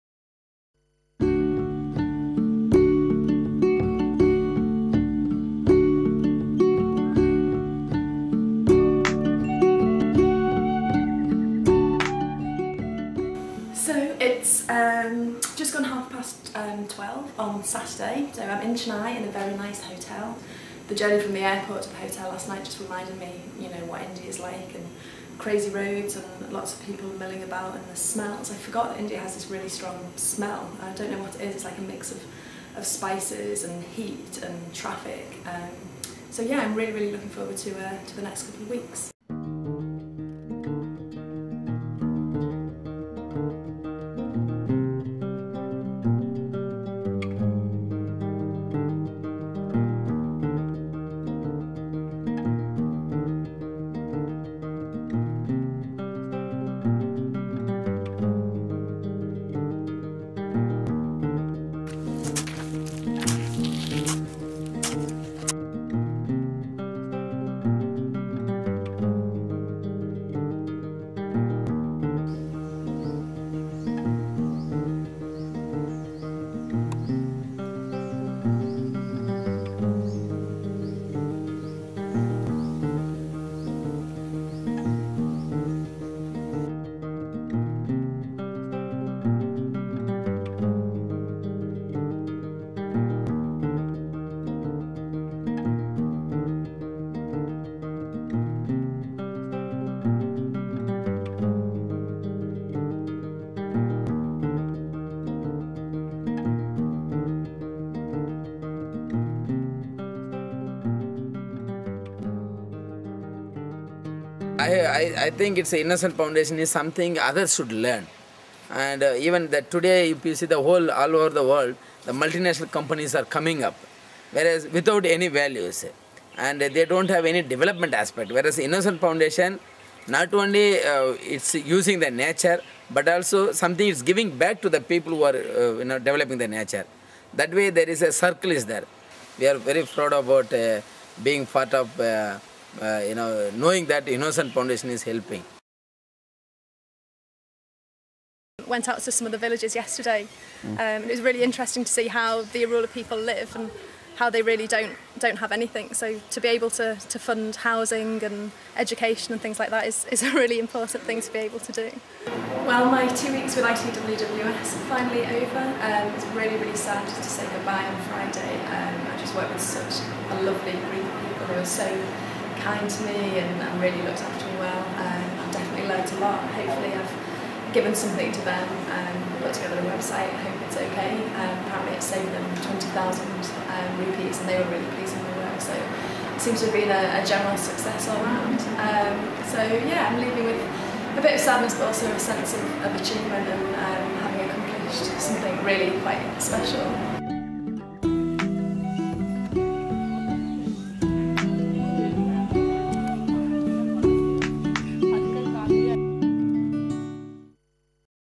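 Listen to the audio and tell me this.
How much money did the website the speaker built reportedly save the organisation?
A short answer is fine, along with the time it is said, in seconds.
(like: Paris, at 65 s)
20,000 rupees, at 182 s.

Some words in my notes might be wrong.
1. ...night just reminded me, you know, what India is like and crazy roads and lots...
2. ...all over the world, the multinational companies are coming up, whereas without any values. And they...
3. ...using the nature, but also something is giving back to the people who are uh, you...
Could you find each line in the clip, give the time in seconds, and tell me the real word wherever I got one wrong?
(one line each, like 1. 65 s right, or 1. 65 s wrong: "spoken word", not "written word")
1. 22 s right
2. 120 s right
3. 131 s right.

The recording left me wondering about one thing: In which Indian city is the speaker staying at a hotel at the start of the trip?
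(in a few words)
Chennai.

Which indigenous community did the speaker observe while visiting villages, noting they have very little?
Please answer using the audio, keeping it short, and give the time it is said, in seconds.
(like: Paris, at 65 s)
Irula, at 152 s.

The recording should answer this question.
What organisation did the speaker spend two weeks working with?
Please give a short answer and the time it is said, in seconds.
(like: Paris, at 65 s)
ITWWS, at 163 s.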